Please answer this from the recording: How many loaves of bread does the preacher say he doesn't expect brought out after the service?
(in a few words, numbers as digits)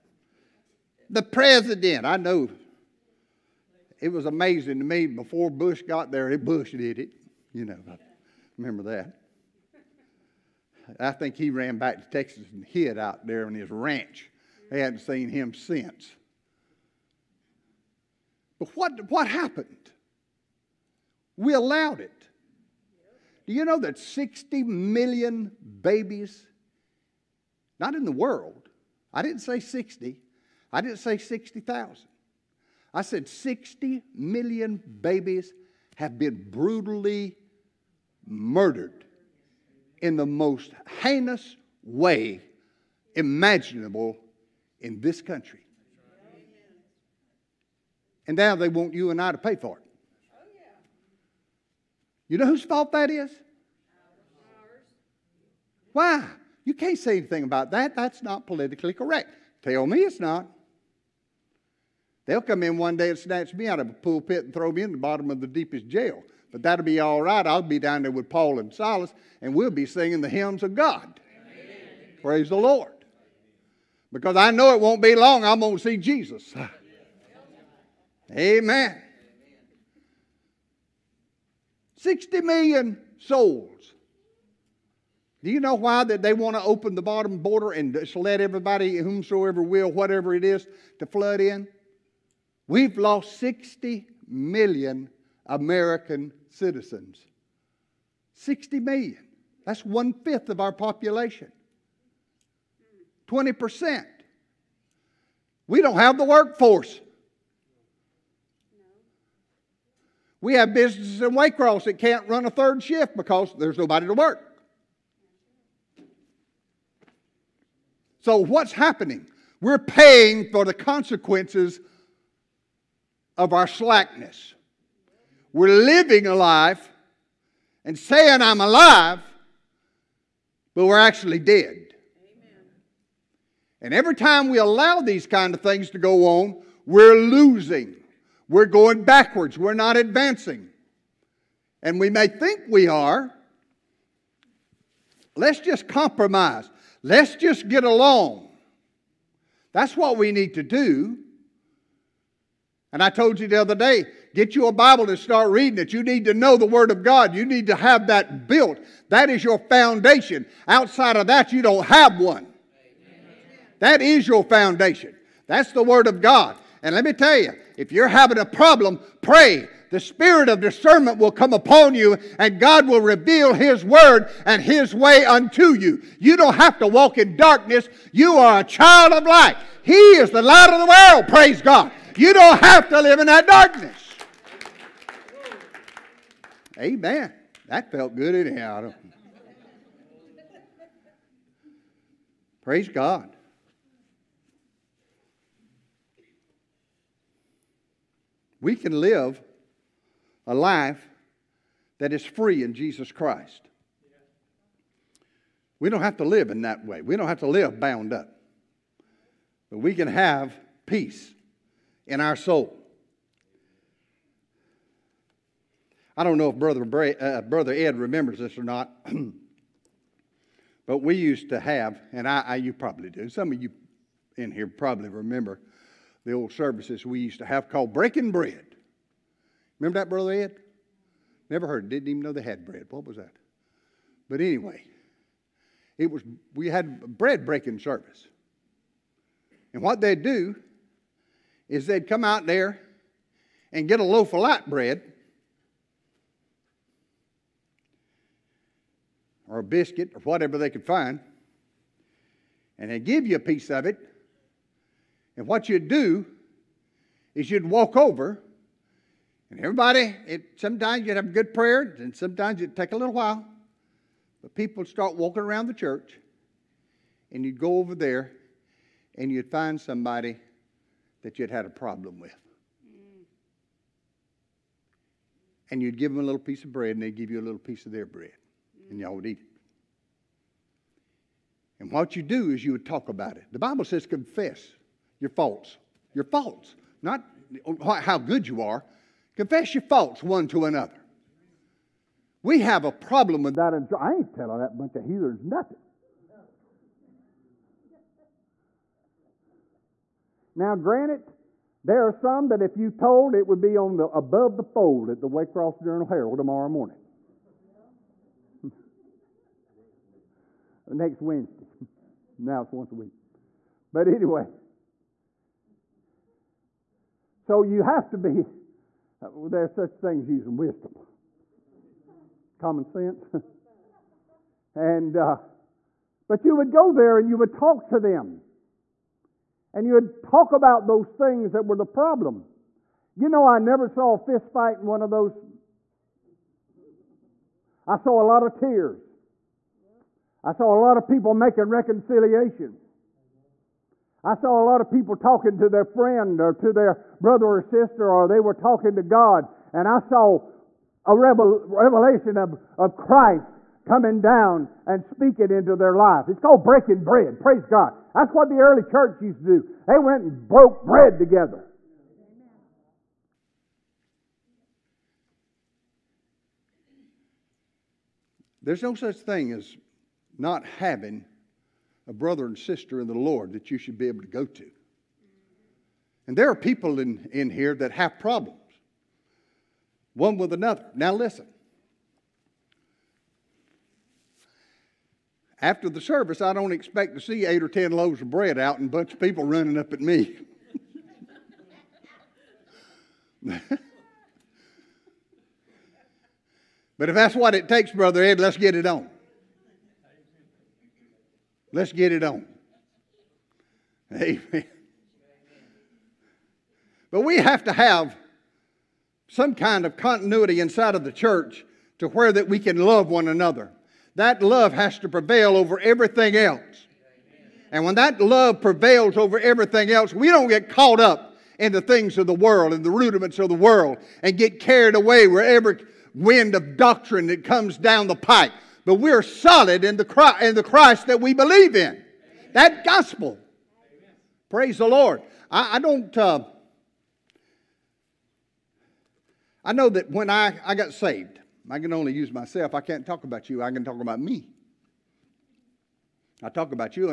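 8 or 10.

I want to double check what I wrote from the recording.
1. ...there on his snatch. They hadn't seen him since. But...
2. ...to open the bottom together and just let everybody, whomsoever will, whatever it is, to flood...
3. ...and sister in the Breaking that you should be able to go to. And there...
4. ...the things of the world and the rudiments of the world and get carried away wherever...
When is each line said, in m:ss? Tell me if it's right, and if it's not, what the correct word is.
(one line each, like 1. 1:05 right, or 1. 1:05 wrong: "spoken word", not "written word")
1. 0:13 wrong: "ranch", not "snatch"
2. 1:26 wrong: "border", not "together"
3. 6:12 wrong: "Lord", not "Breaking"
4. 7:01 right.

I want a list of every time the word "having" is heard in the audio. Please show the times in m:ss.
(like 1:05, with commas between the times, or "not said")
2:48, 6:10.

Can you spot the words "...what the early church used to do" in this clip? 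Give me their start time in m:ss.
5:58.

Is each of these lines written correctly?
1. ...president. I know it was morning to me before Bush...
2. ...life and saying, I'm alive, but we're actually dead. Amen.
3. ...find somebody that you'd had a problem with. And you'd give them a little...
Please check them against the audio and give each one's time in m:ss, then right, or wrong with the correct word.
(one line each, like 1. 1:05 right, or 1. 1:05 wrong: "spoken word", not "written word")
1. 0:01 wrong: "amazing", not "morning"
2. 2:06 right
3. 4:29 right.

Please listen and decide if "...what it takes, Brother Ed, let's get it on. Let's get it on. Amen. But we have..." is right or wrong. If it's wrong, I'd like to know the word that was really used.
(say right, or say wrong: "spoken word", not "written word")
right.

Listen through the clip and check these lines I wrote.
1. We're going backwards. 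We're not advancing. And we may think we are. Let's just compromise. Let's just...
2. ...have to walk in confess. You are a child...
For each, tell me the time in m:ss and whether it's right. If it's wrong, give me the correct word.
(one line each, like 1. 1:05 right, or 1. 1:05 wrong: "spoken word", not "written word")
1. 2:18 right
2. 2:56 wrong: "darkness", not "confess".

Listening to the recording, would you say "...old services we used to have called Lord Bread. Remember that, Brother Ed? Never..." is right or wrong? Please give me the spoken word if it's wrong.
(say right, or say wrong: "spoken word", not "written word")
wrong: "Breaking", not "Lord".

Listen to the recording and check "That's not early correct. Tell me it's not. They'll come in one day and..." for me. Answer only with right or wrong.
wrong.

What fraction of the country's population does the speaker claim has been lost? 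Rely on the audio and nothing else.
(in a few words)
one fifth.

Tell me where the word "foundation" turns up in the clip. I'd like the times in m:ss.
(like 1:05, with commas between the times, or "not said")
2:39, 2:44.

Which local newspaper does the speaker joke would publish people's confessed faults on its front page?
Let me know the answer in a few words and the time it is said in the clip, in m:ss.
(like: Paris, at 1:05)
Waycross Journal Herald, at 5:05.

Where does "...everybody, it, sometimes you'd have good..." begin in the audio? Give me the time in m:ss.
4:19.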